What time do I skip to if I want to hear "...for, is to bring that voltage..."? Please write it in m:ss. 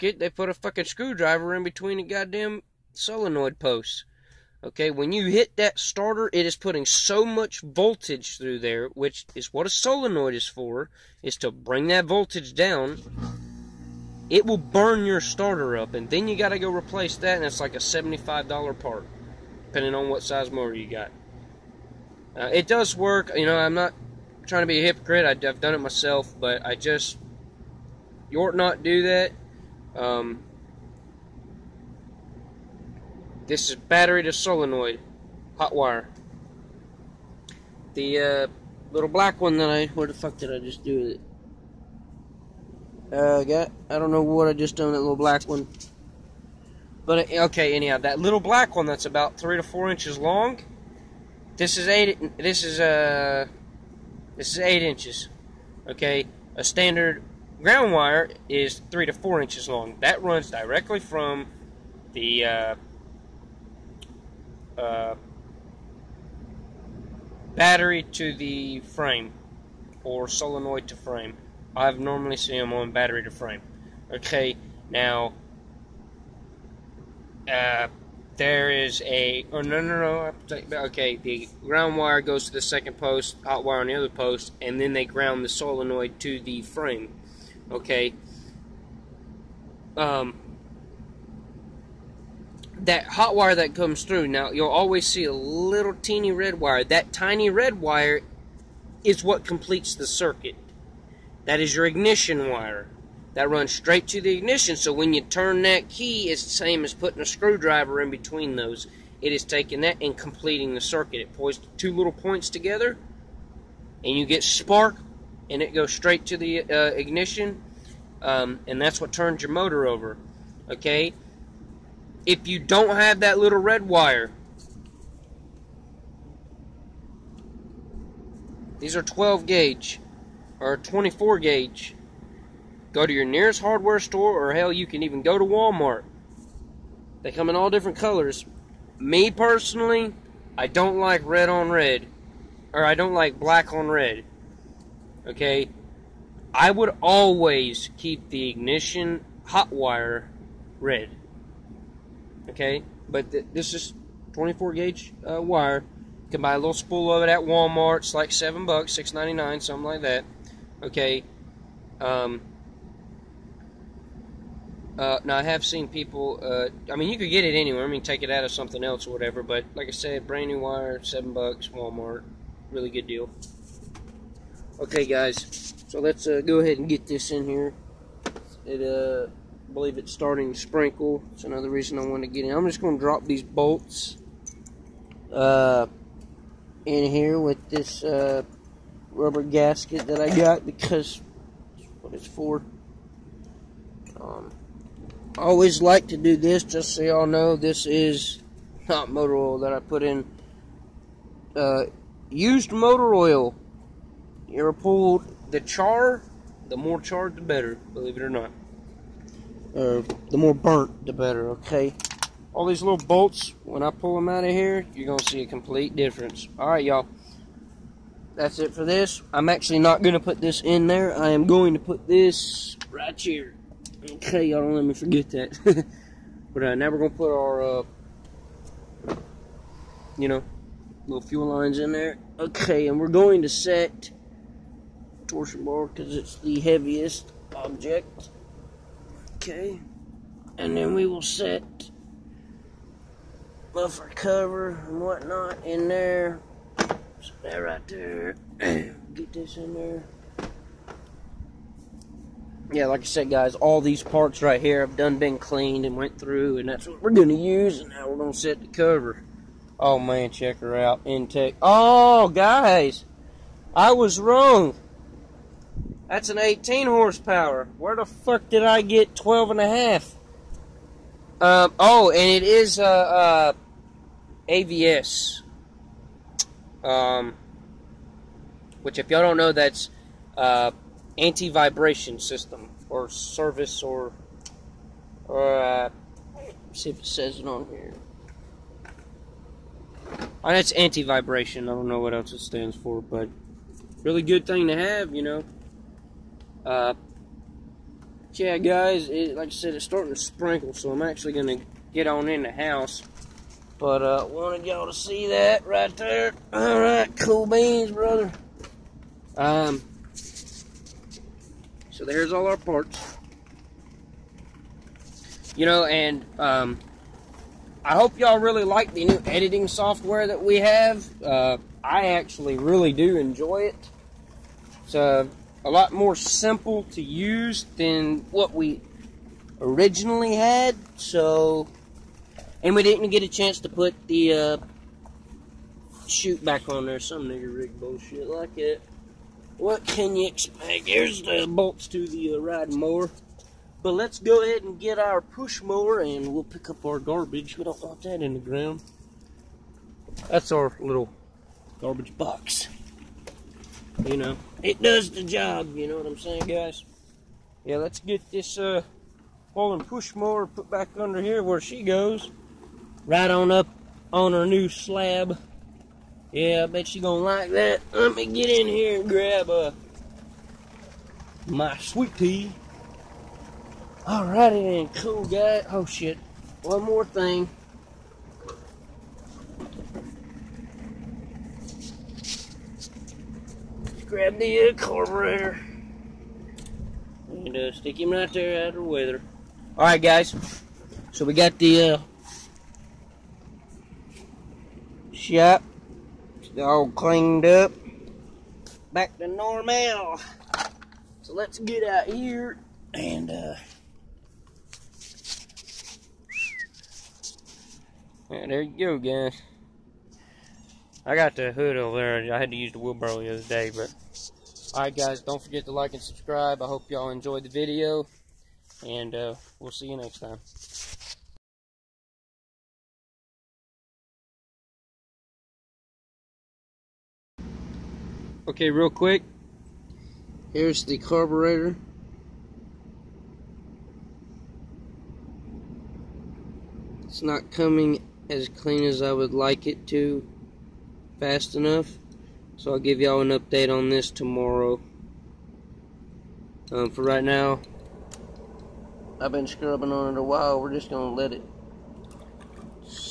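0:10.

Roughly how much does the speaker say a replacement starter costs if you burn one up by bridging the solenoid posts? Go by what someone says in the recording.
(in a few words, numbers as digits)
$75.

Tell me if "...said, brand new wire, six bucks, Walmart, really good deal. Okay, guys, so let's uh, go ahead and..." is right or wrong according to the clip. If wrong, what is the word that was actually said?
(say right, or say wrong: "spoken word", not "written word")
wrong: "seven", not "six".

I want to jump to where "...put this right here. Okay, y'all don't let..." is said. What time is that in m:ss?
3:41.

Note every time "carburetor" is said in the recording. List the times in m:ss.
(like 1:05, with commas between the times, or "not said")
6:24, 7:10.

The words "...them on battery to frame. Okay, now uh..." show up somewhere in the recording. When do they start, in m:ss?
1:12.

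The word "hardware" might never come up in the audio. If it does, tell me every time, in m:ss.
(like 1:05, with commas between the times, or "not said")
2:13.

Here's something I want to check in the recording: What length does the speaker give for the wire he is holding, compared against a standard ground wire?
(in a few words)
8 inches.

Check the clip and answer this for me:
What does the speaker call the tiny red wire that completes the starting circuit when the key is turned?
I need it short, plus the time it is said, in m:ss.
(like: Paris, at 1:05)
ignition wire, at 1:41.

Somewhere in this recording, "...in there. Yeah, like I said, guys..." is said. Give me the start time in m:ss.
4:09.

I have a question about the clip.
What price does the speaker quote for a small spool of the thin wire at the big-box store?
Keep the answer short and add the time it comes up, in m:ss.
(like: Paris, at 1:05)
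$6.99, at 2:38.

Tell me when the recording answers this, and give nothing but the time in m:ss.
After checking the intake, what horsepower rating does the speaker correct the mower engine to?
4:26.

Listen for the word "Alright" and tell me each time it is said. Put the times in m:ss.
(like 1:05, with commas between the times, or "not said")
5:06, 6:29, 6:54.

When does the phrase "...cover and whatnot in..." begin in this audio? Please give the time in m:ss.
4:04.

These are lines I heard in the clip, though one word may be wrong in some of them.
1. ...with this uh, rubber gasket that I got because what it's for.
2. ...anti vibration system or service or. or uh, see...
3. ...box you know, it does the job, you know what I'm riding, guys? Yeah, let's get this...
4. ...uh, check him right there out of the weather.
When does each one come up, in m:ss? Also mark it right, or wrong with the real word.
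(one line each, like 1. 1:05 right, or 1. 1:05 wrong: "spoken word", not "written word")
1. 3:07 right
2. 4:41 right
3. 5:52 wrong: "saying", not "riding"
4. 6:27 wrong: "stick", not "check".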